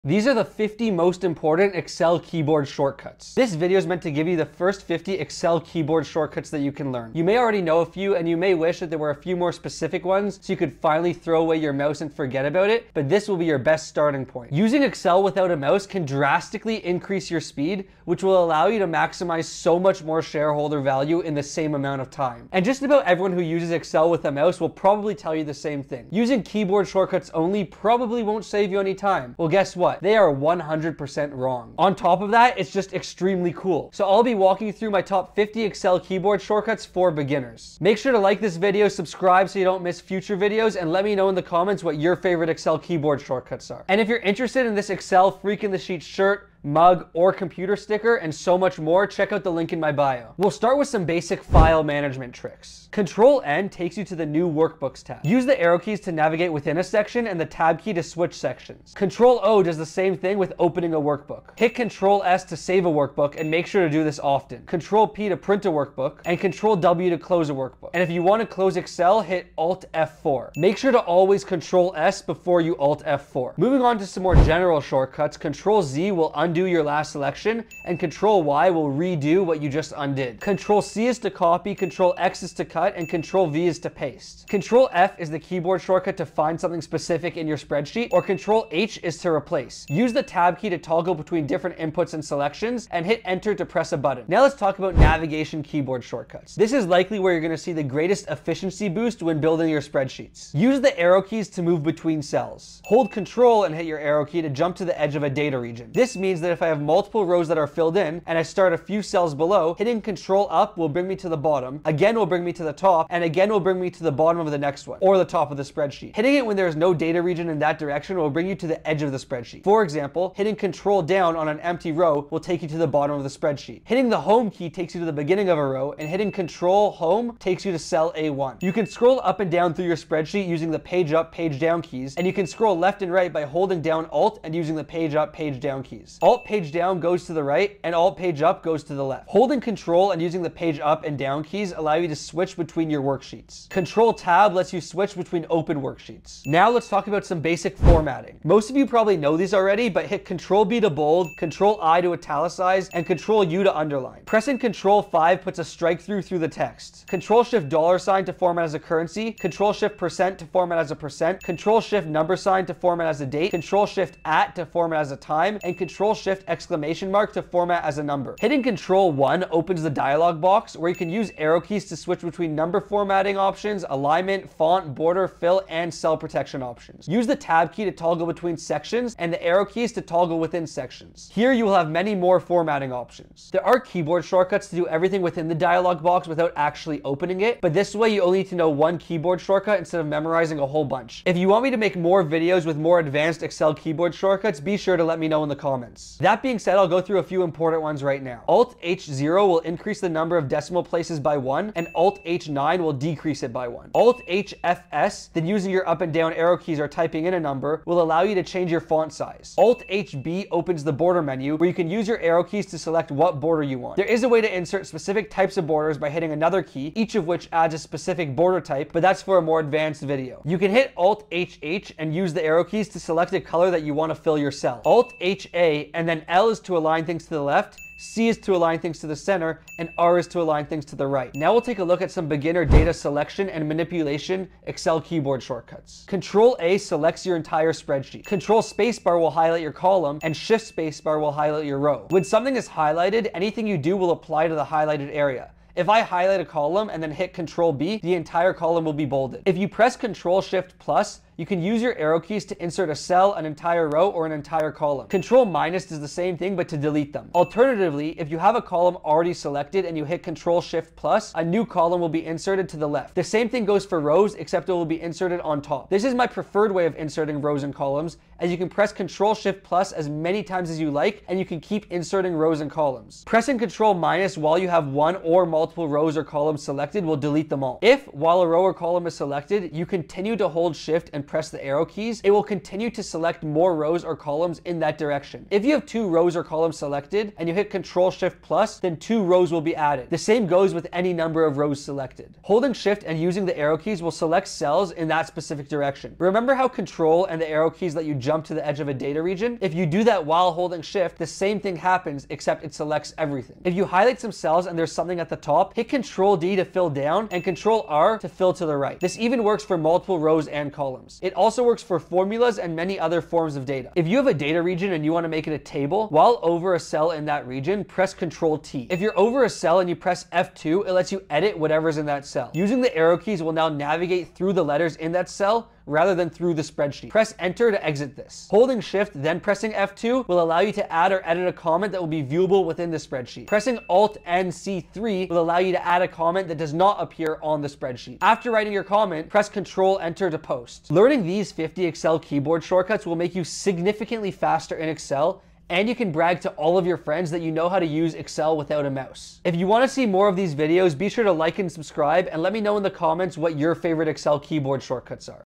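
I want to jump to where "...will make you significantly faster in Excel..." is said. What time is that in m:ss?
5:43.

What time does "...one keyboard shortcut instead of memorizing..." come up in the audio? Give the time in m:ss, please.
3:08.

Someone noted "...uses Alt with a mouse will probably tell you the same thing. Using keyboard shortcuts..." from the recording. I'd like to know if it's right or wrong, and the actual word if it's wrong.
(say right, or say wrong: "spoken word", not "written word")
wrong: "Excel", not "Alt".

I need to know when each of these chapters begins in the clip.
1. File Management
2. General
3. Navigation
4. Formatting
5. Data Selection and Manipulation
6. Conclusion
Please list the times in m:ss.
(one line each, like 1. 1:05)
1. 0:50
2. 1:13
3. 1:34
4. 2:26
5. 3:51
6. 5:40.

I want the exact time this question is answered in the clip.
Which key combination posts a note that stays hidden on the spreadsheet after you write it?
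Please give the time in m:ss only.
5:39.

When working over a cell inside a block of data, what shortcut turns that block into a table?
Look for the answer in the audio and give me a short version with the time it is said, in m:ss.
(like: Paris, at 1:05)
Control T, at 5:18.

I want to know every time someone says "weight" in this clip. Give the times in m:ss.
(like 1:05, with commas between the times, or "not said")
not said.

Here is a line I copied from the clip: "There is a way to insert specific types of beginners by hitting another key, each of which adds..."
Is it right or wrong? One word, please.
wrong.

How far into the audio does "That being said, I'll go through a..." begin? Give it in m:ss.
3:16.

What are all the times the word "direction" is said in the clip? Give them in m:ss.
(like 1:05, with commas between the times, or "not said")
1:57, 4:44, 4:55.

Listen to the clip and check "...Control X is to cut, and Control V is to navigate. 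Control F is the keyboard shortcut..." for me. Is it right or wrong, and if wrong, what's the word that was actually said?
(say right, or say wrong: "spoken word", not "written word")
wrong: "paste", not "navigate".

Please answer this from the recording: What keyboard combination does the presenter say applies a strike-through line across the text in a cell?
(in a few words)
Control 5.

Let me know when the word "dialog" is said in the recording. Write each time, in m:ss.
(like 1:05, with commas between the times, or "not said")
2:49, 3:05.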